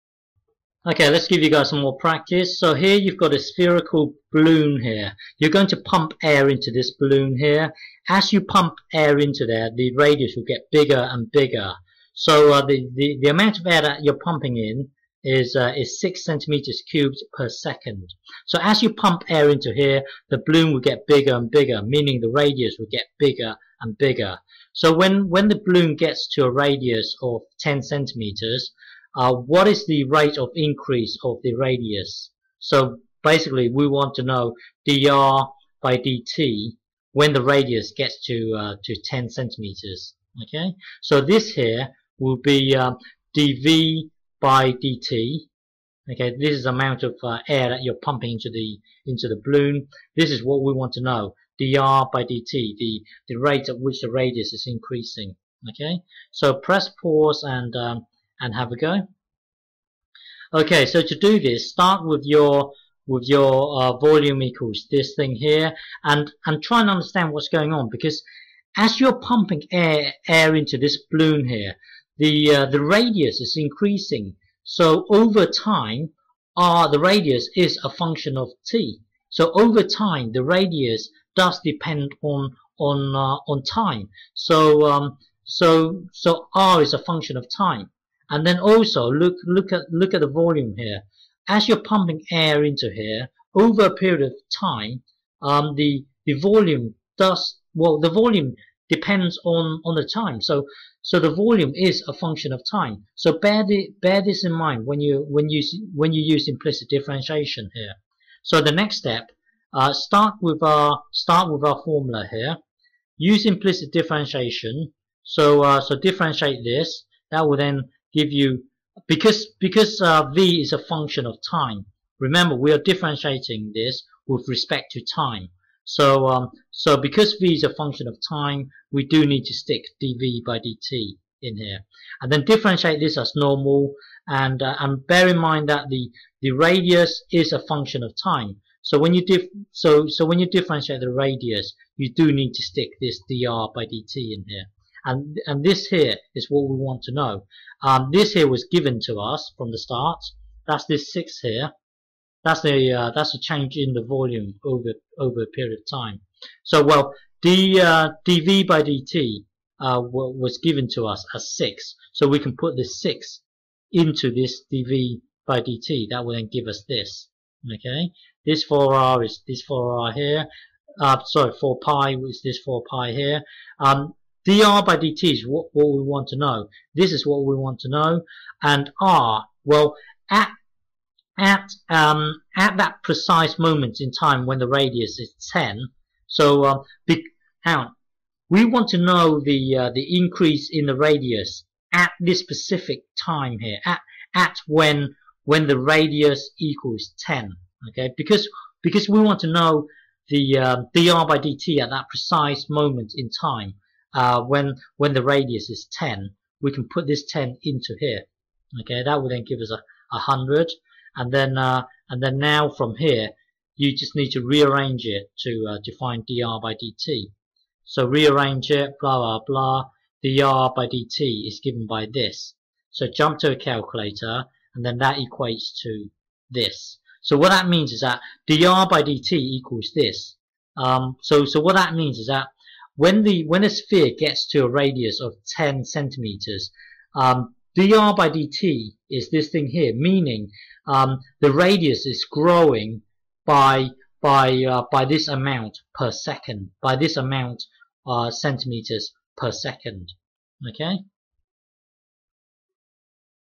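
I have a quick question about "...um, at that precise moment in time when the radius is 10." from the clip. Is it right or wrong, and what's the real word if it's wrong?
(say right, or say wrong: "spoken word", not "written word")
right.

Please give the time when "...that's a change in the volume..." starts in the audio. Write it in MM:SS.
02:33.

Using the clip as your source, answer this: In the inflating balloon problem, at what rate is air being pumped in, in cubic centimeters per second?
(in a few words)
6.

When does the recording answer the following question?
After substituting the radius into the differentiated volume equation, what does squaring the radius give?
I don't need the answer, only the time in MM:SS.
03:30.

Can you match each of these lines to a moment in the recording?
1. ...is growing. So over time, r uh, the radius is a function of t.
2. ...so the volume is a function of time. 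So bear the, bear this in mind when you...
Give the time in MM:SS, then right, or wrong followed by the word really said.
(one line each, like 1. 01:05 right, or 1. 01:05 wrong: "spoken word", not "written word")
1. 01:13 wrong: "increasing", not "growing"
2. 01:41 right.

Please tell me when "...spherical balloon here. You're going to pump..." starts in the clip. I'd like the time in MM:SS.
00:03.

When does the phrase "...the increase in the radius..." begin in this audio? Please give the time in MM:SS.
03:09.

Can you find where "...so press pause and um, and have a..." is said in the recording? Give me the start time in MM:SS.
00:56.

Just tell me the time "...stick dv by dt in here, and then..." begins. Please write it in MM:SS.
02:09.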